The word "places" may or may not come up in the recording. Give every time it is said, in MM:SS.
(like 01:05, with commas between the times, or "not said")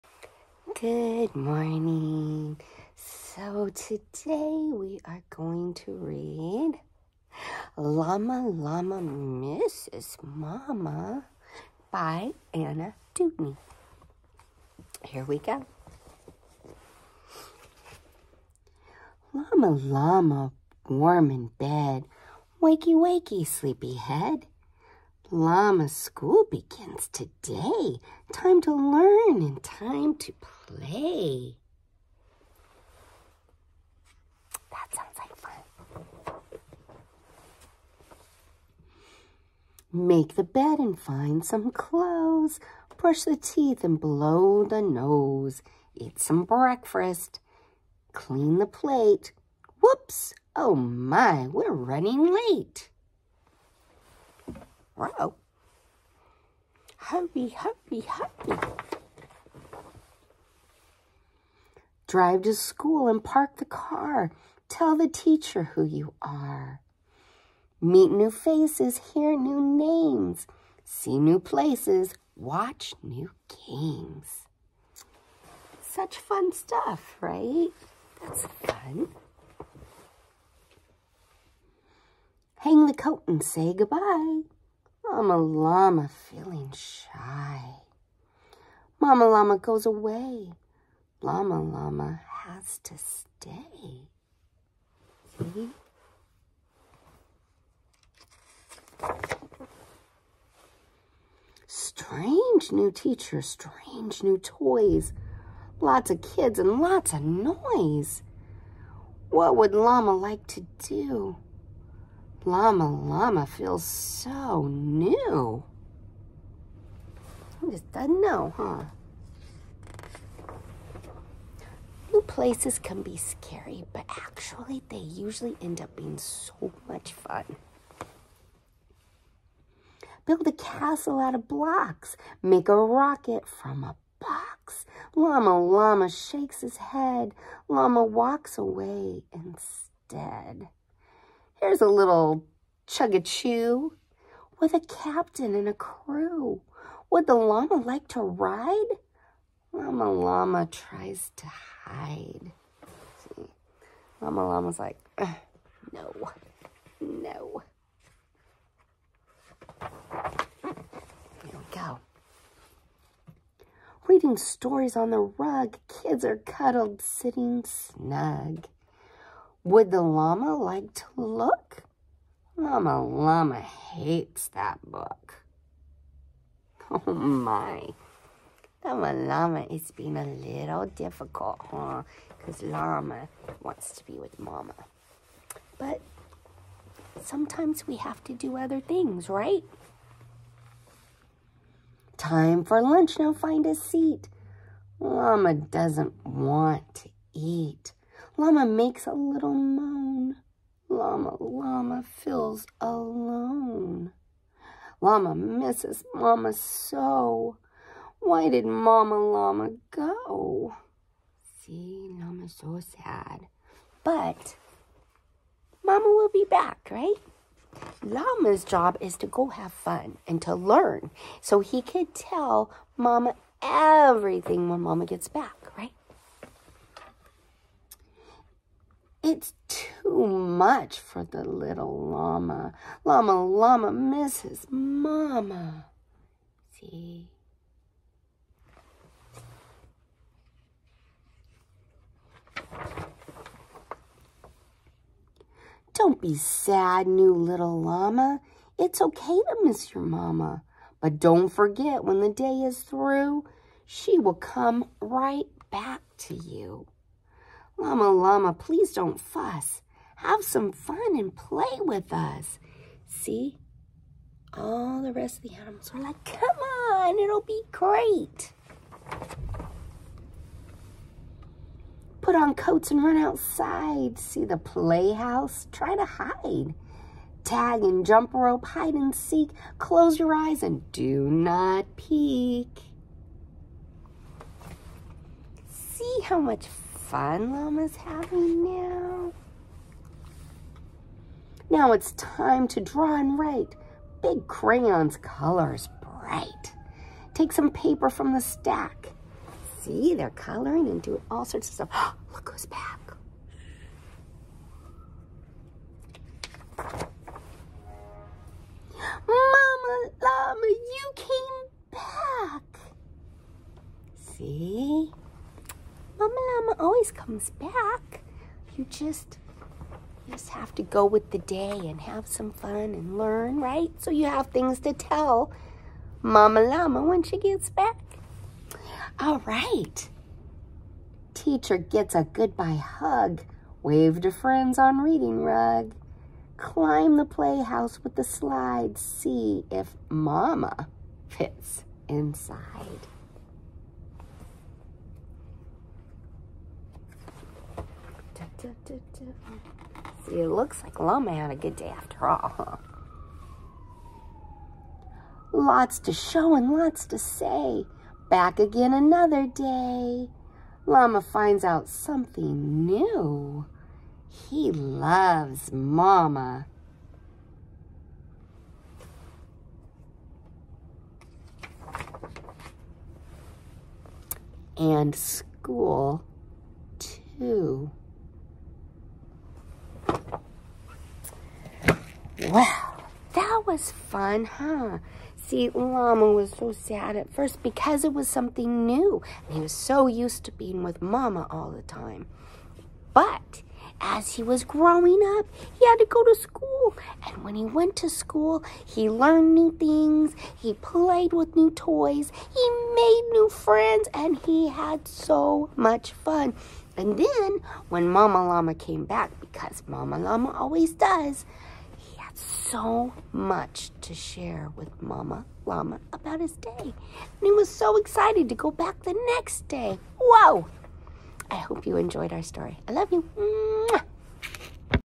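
01:11, 02:02.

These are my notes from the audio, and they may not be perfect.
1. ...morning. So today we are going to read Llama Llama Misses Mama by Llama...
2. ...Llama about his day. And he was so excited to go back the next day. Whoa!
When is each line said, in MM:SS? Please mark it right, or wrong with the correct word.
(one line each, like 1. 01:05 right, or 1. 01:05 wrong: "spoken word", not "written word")
1. 00:01 wrong: "Anna", not "Llama"
2. 06:55 right.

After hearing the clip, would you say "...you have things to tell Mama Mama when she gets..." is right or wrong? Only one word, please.
wrong.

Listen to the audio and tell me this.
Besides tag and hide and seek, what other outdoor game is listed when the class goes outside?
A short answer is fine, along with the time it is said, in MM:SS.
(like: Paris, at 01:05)
Jump rope, at 04:38.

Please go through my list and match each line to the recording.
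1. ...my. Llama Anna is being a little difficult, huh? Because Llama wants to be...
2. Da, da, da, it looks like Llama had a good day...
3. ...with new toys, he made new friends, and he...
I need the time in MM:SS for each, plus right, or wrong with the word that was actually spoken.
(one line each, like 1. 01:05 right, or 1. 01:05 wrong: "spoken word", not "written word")
1. 02:57 wrong: "Llama", not "Anna"
2. 05:48 right
3. 06:41 right.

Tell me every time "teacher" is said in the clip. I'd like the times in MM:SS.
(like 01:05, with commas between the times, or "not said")
01:05, 01:42, 05:31.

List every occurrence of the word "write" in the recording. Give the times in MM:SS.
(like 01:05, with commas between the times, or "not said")
04:53.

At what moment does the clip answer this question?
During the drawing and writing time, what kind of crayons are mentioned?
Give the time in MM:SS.
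04:54.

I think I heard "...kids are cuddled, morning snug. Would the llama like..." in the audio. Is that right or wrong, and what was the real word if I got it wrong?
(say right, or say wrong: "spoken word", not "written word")
wrong: "sitting", not "morning".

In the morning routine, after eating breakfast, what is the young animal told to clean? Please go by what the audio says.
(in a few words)
The plate.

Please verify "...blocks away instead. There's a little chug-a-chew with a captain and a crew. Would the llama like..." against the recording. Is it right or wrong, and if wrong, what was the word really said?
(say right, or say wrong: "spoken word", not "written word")
wrong: "walks", not "blocks".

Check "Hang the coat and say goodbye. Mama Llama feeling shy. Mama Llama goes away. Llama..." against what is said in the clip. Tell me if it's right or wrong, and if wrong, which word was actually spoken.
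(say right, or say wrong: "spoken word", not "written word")
right.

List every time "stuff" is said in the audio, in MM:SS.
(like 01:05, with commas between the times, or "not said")
01:16, 05:01.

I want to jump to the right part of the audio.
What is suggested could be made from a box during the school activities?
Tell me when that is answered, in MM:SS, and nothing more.
02:12.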